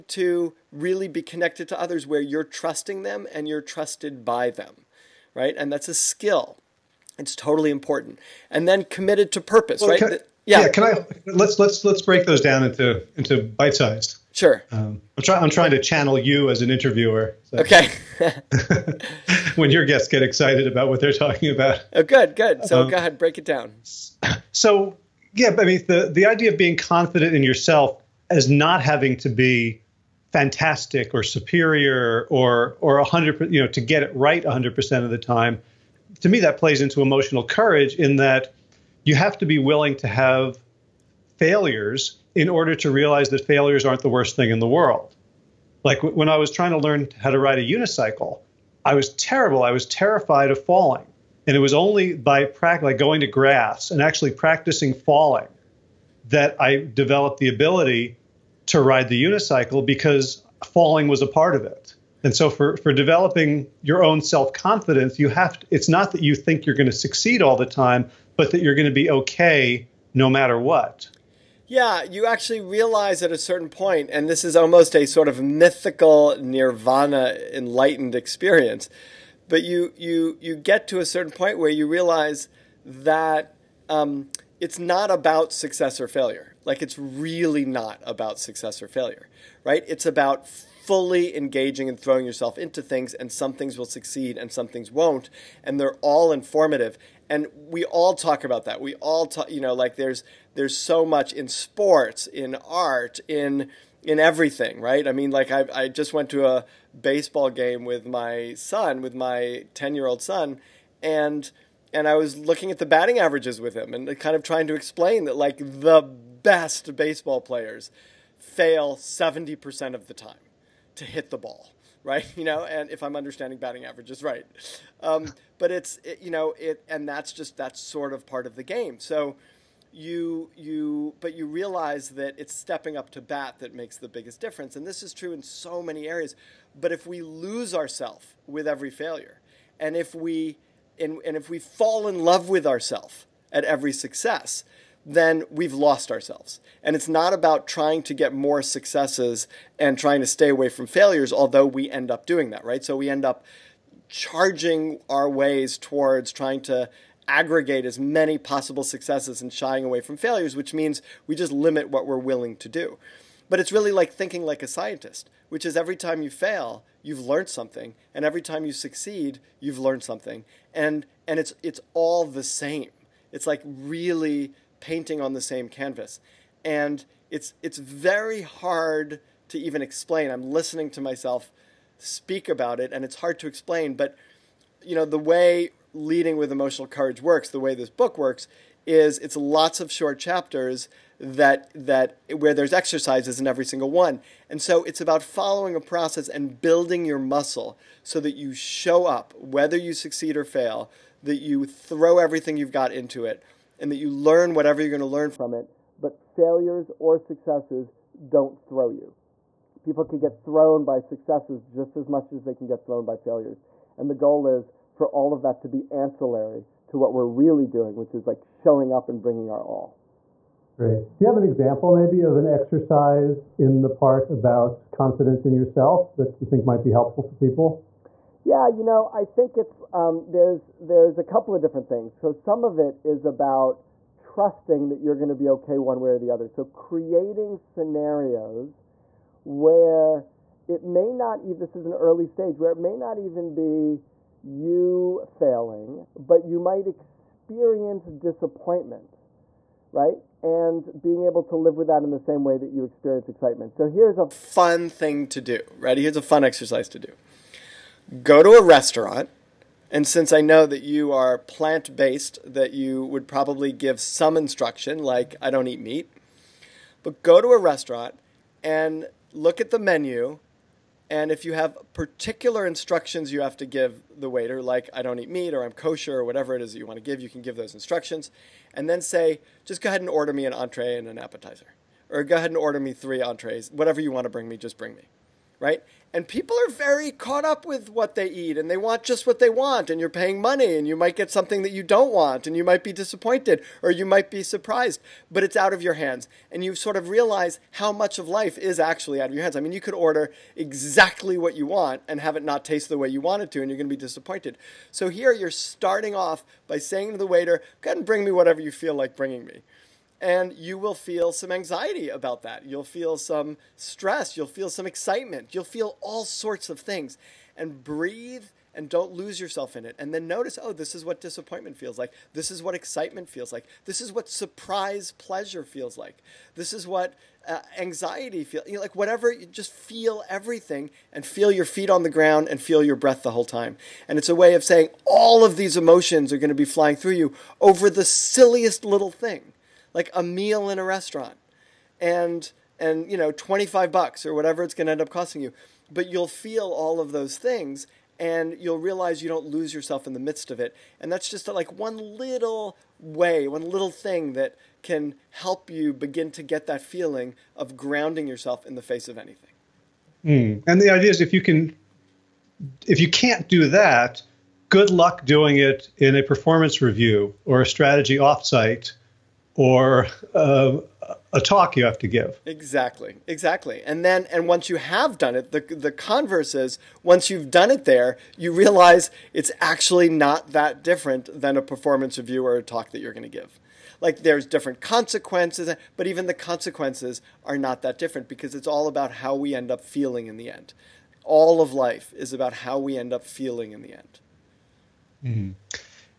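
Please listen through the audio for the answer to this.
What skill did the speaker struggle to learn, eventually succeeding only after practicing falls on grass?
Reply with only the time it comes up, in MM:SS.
00:47.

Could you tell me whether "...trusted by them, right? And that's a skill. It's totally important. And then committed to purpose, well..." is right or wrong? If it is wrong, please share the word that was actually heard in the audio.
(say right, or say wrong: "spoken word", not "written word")
right.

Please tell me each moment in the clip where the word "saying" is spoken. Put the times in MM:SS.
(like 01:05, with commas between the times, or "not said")
05:06, 05:34.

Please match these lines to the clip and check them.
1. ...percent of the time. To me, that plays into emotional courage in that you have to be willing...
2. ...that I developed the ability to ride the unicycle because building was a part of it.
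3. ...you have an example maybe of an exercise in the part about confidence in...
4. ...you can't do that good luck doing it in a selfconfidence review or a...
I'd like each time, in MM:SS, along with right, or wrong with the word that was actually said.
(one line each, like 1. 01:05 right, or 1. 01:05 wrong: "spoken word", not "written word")
1. 00:34 right
2. 00:56 wrong: "falling", not "building"
3. 03:41 right
4. 06:03 wrong: "performance", not "selfconfidence".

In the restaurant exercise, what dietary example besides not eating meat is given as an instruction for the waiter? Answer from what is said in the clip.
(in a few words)
kosher.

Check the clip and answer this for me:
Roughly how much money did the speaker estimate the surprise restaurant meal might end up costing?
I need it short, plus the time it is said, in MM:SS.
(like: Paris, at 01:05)
$25, at 05:43.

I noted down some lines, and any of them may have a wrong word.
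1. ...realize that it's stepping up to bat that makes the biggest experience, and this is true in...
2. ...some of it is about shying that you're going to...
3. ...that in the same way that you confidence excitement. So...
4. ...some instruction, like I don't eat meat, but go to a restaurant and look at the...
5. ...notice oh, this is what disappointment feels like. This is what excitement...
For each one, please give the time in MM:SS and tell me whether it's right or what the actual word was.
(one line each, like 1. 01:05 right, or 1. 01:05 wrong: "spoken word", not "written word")
1. 02:11 wrong: "difference", not "experience"
2. 03:52 wrong: "trusting", not "shying"
3. 04:11 wrong: "experience", not "confidence"
4. 04:24 right
5. 05:20 right.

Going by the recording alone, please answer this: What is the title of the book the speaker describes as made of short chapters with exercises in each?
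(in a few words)
Leading with Emotional Courage.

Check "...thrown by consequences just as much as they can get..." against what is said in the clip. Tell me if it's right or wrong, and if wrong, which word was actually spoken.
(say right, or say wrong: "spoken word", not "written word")
wrong: "successes", not "consequences".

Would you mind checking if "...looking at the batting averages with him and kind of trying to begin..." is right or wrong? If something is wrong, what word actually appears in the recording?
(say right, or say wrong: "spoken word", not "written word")
wrong: "explain", not "begin".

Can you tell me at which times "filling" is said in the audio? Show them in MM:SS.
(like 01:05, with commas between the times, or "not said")
not said.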